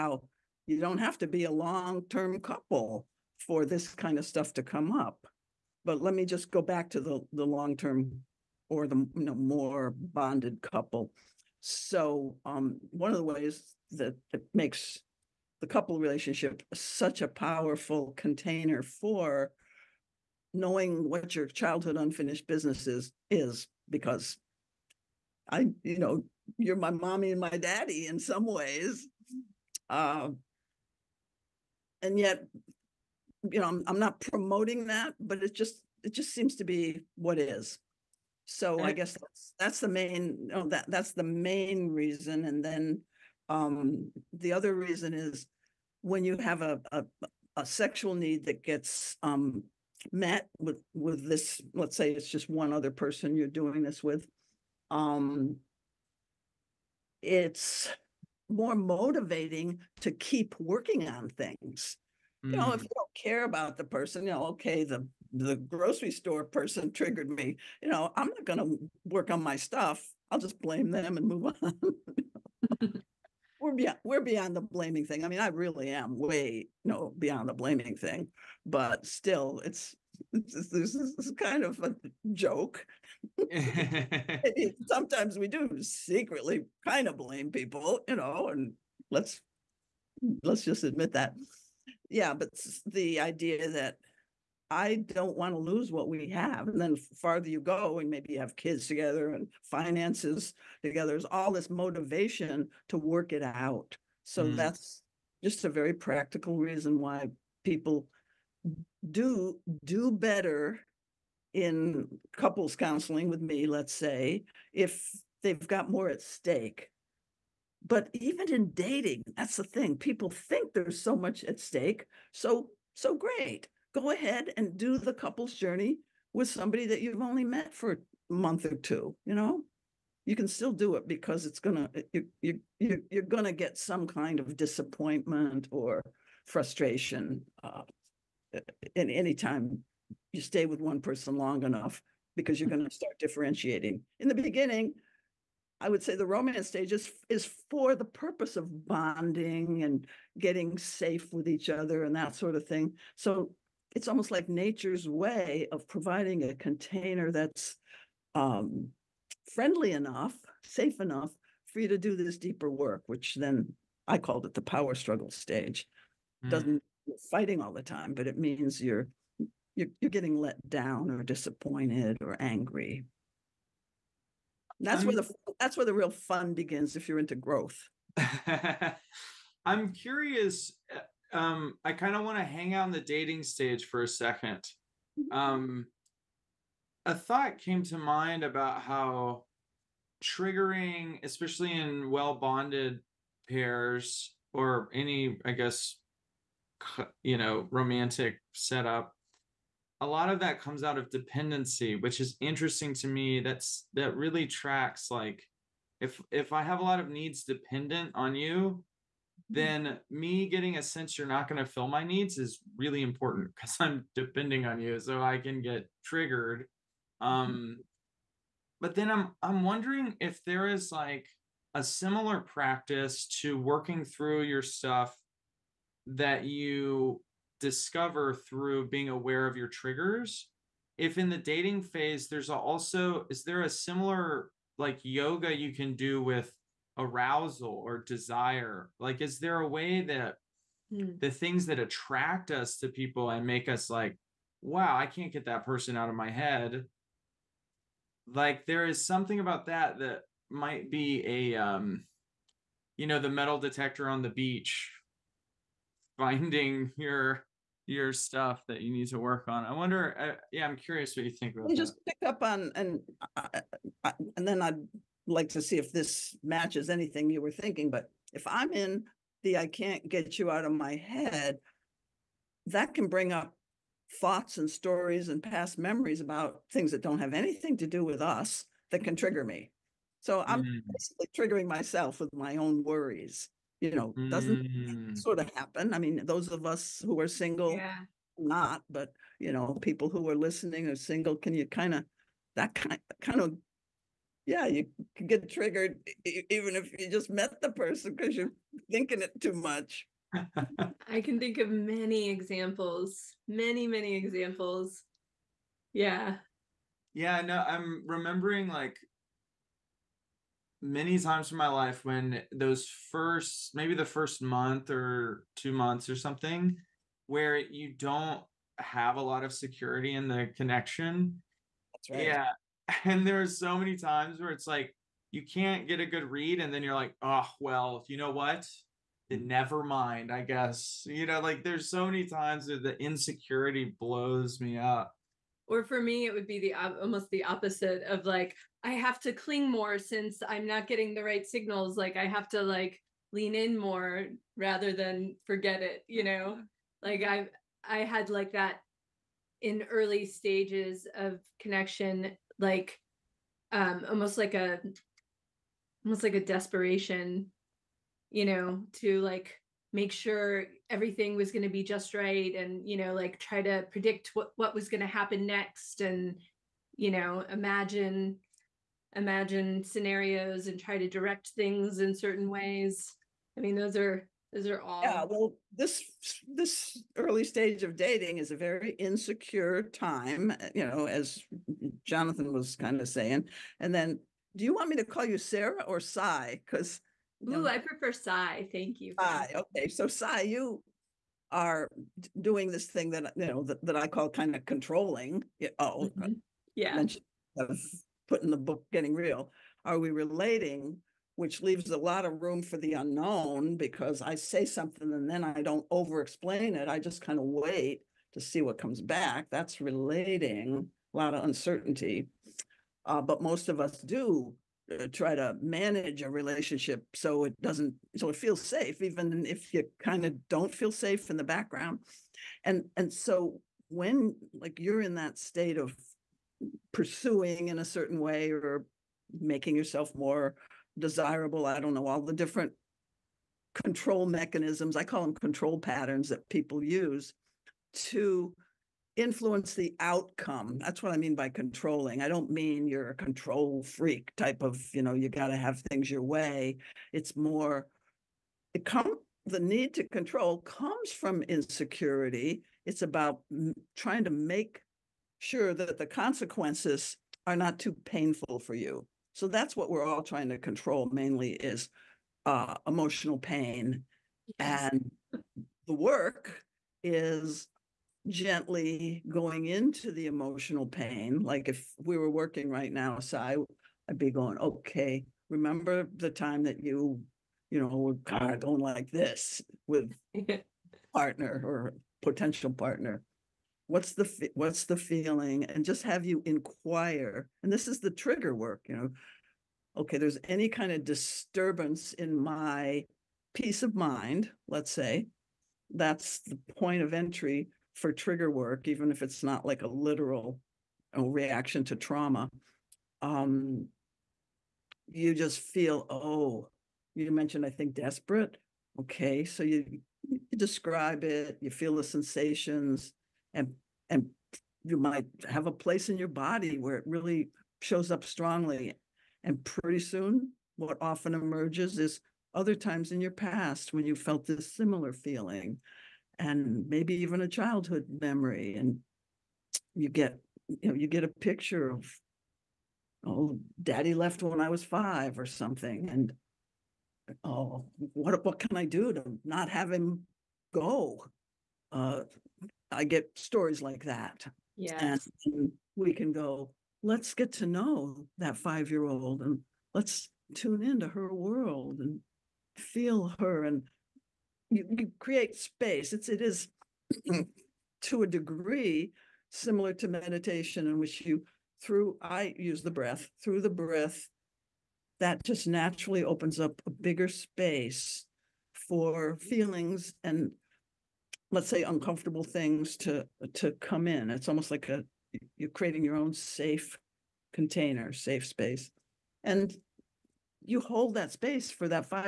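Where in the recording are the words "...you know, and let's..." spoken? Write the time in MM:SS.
01:28.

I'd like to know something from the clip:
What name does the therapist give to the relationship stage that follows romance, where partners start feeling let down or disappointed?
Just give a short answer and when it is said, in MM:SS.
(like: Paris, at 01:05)
power struggle stage, at 02:44.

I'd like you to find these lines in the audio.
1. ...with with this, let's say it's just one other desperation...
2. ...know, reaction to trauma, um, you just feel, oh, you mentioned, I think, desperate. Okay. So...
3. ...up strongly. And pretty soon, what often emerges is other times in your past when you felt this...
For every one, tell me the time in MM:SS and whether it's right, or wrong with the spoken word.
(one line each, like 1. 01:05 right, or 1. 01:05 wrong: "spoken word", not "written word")
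1. 00:50 wrong: "person", not "desperation"
2. 08:21 right
3. 08:38 right.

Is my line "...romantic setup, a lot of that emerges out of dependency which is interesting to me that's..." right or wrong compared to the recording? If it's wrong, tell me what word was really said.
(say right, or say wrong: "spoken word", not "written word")
wrong: "comes", not "emerges".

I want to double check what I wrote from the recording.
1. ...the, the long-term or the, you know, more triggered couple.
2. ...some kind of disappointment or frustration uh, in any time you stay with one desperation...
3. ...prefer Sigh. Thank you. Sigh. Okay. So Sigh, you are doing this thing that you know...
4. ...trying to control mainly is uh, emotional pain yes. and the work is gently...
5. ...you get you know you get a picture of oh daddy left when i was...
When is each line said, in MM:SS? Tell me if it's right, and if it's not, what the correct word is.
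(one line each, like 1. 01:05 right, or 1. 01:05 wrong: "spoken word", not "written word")
1. 00:06 wrong: "bonded", not "triggered"
2. 02:13 wrong: "person", not "desperation"
3. 06:27 right
4. 07:40 right
5. 08:49 right.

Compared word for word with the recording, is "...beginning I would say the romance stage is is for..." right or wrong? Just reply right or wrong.
right.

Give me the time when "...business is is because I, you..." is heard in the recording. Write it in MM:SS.
00:22.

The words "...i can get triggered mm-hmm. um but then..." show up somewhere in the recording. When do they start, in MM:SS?
03:35.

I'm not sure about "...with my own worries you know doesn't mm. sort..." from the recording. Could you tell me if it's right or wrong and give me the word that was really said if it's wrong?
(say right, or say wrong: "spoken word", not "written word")
right.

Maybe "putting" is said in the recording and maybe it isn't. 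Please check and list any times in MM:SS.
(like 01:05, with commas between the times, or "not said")
06:38.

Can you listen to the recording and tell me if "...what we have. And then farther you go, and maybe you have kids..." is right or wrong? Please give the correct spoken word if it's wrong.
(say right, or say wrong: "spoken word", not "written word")
right.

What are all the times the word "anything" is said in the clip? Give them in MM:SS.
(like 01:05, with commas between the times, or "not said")
04:26, 04:37.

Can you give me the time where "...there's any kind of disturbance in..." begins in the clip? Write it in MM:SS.
08:10.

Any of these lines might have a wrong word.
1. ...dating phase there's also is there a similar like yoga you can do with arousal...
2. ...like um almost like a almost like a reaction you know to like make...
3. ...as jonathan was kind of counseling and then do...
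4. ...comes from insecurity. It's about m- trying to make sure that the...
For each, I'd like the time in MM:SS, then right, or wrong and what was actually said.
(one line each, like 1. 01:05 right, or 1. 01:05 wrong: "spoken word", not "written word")
1. 03:51 right
2. 05:52 wrong: "desperation", not "reaction"
3. 06:21 wrong: "saying", not "counseling"
4. 07:30 right.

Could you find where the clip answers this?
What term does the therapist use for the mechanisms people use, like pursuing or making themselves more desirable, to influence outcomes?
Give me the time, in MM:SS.
07:15.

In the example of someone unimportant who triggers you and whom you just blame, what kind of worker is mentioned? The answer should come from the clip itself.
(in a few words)
grocery store person.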